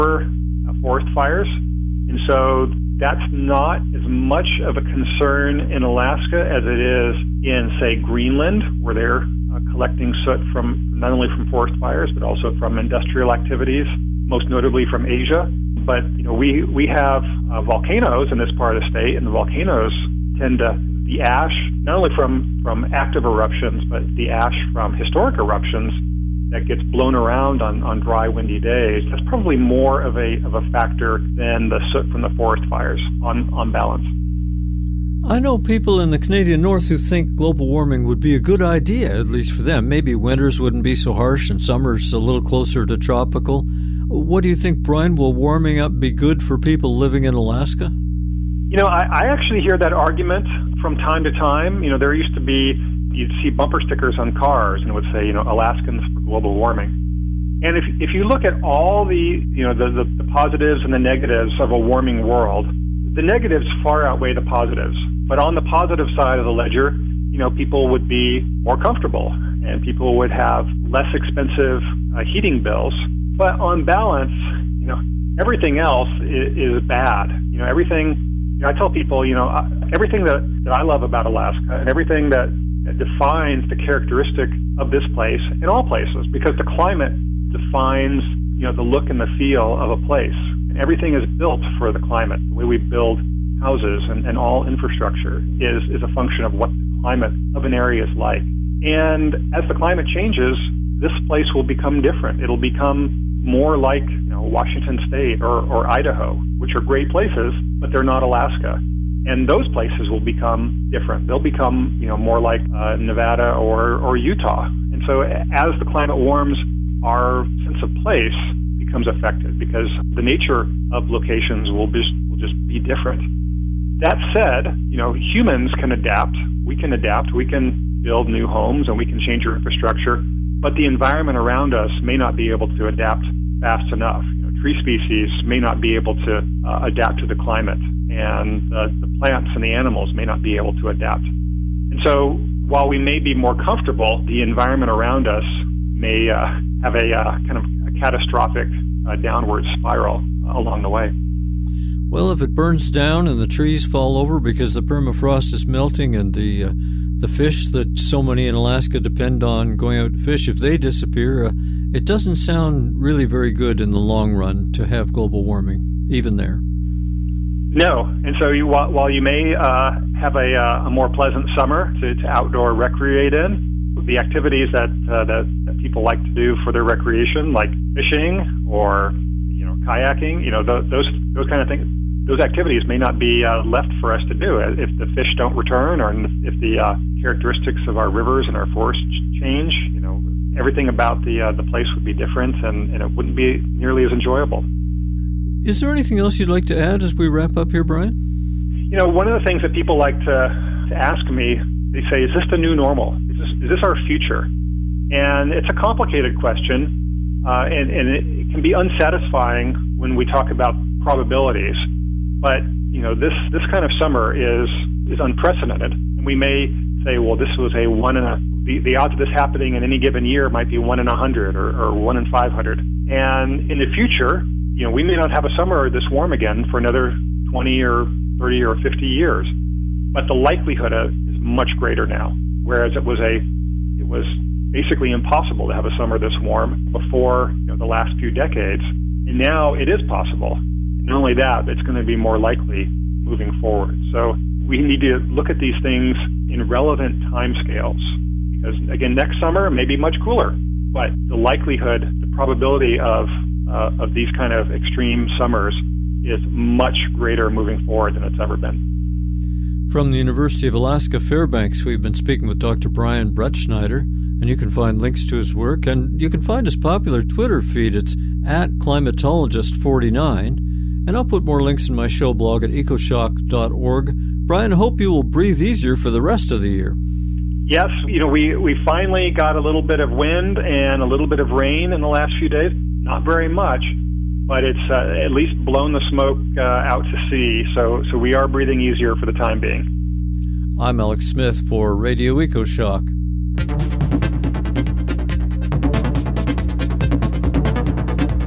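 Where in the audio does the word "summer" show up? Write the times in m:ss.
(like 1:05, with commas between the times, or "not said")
0:41, 2:51, 3:33, 3:45, 3:55, 4:09, 4:15.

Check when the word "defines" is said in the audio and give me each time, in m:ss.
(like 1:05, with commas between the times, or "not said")
1:22, 1:27.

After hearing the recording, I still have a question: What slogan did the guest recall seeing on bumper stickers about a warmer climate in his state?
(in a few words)
Alaskans for global warming.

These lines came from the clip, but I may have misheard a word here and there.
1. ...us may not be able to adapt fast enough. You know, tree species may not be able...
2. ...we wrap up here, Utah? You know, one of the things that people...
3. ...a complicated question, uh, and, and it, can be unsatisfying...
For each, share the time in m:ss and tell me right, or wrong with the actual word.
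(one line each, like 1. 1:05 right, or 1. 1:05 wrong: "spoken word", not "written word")
1. 2:11 right
2. 3:17 wrong: "Brian", not "Utah"
3. 3:25 right.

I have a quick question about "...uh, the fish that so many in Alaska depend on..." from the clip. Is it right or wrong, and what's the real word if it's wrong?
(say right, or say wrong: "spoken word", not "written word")
right.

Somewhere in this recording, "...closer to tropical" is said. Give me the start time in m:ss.
0:42.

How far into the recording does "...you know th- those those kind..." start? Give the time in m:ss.
3:00.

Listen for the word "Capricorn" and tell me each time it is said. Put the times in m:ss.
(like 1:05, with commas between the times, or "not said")
not said.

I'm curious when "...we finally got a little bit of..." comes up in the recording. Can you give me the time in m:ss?
4:38.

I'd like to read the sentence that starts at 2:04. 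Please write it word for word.
That said, you know humans can adapt.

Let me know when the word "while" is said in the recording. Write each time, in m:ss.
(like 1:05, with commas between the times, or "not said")
2:22, 2:48.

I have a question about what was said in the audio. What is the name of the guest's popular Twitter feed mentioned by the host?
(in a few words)
climatologist49.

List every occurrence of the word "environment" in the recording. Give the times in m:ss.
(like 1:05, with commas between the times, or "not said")
2:10, 2:24.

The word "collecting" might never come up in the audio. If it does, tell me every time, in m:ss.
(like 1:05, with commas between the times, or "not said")
0:09.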